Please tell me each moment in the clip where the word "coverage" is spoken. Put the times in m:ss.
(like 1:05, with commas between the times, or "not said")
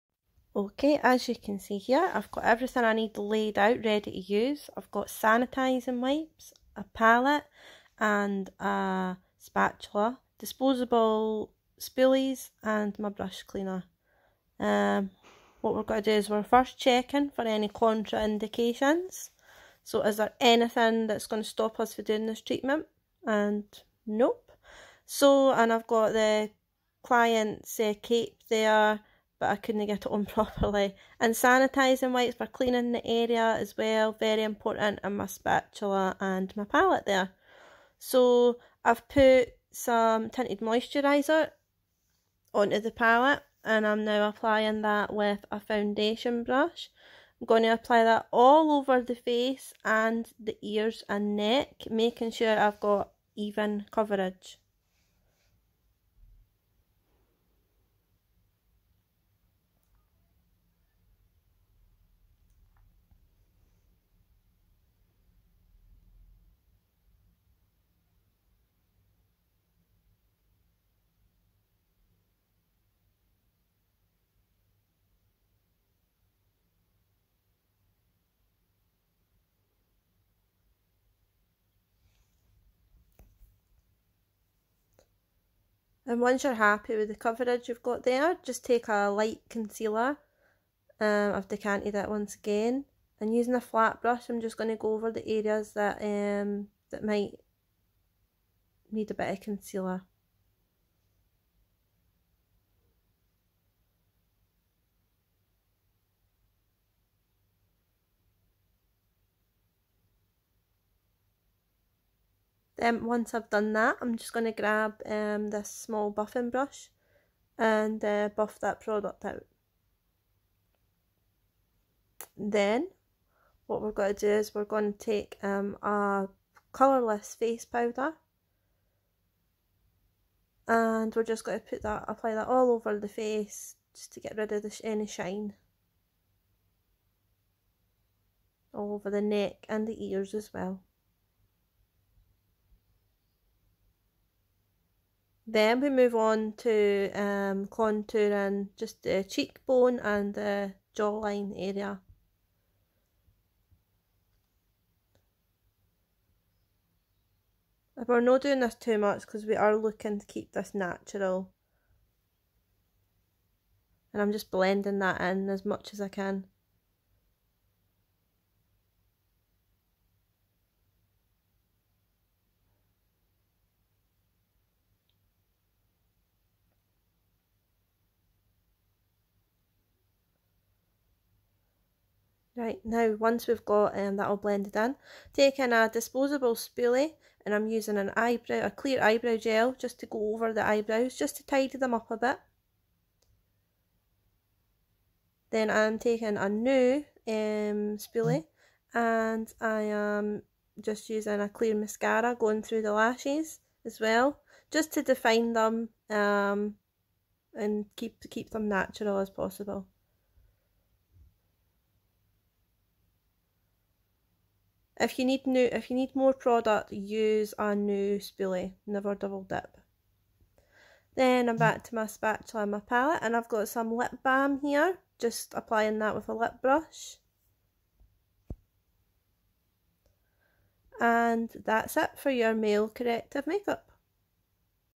0:53, 1:27.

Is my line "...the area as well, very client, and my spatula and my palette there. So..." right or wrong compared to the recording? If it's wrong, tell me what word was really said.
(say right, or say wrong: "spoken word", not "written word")
wrong: "important", not "client".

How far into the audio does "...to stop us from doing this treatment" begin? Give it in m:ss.
0:21.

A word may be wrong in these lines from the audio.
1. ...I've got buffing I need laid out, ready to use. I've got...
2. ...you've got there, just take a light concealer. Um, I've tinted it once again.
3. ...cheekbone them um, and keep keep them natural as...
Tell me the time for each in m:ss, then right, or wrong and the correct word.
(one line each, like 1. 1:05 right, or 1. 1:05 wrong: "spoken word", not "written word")
1. 0:02 wrong: "everything", not "buffing"
2. 1:27 wrong: "decanted", not "tinted"
3. 3:25 wrong: "define", not "cheekbone".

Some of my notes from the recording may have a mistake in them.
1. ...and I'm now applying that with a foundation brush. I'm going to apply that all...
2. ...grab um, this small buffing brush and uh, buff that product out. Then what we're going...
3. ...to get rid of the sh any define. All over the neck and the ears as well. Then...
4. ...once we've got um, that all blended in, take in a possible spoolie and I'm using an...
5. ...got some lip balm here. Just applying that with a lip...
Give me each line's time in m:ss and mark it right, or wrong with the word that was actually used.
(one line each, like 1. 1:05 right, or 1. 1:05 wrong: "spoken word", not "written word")
1. 0:43 right
2. 1:54 right
3. 2:14 wrong: "shine", not "define"
4. 3:03 wrong: "disposable", not "possible"
5. 3:43 right.